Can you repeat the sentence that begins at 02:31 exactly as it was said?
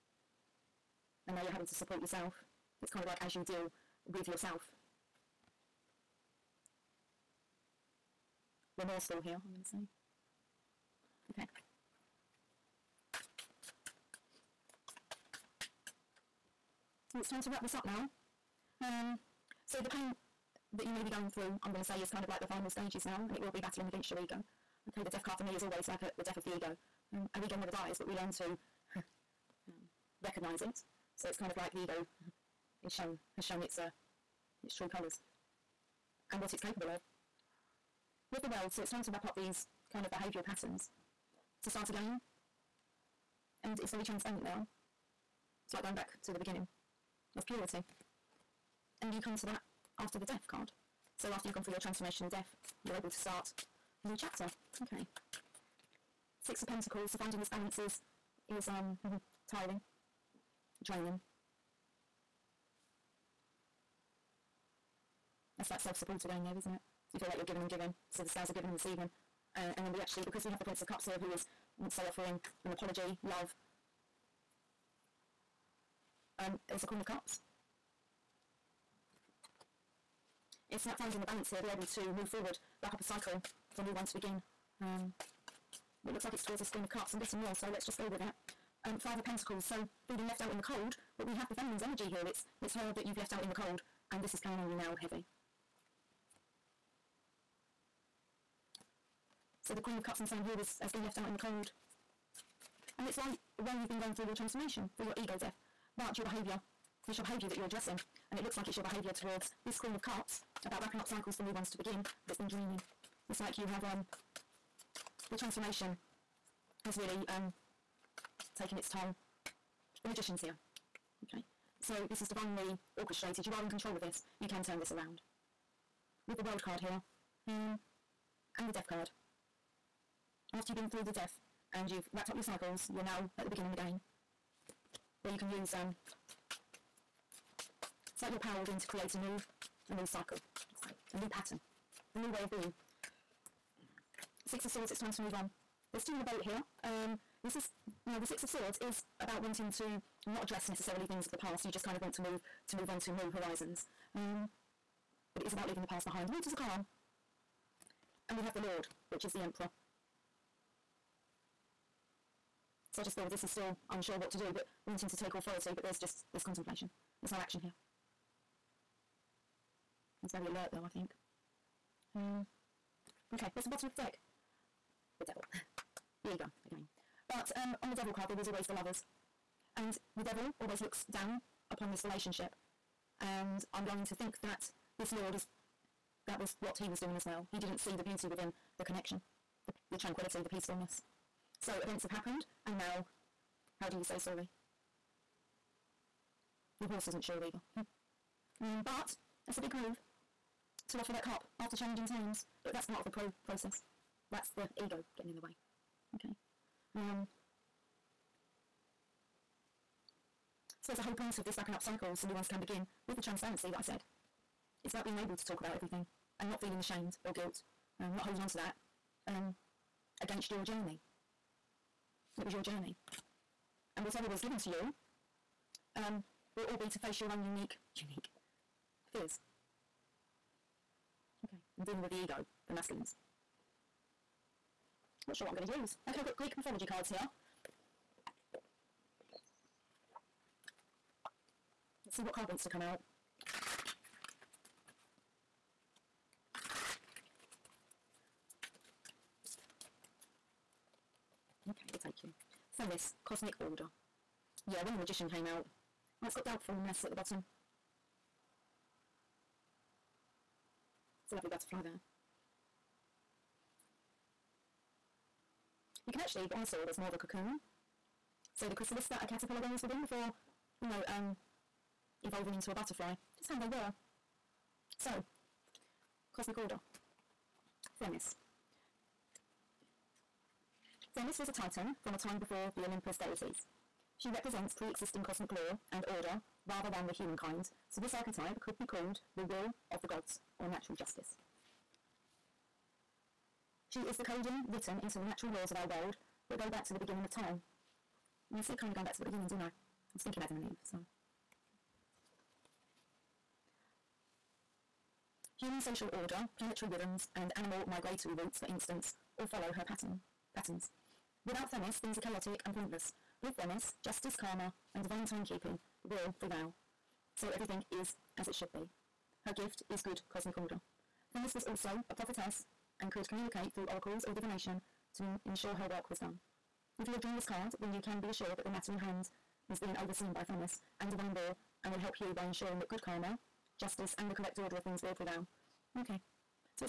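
You just kind of want to move, to move on to new horizons.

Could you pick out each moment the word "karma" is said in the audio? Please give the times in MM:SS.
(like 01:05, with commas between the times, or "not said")
05:14, 05:33.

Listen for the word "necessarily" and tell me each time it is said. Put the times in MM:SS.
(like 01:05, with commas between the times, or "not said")
02:30.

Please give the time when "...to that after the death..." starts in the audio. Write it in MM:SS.
00:49.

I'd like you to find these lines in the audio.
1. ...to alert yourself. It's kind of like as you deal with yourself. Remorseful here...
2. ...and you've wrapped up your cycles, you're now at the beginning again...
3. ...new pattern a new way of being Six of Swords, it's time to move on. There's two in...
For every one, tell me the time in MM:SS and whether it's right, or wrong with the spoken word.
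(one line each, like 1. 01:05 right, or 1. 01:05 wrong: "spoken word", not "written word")
1. 00:01 wrong: "support", not "alert"
2. 02:11 right
3. 02:21 right.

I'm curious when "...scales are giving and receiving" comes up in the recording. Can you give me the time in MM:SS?
01:08.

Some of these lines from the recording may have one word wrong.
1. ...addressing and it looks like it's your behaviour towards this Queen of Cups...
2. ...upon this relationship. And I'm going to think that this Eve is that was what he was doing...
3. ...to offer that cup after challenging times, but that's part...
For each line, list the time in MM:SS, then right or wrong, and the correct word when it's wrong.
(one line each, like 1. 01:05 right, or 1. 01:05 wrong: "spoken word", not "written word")
1. 01:47 right
2. 03:01 wrong: "Lord", not "Eve"
3. 03:20 right.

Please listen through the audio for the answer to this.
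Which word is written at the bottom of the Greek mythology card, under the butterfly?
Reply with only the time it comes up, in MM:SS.
04:16.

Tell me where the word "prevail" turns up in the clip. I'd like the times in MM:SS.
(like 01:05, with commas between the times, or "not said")
05:16, 05:35.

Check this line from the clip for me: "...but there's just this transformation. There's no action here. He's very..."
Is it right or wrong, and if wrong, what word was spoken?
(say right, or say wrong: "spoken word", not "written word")
wrong: "contemplation", not "transformation".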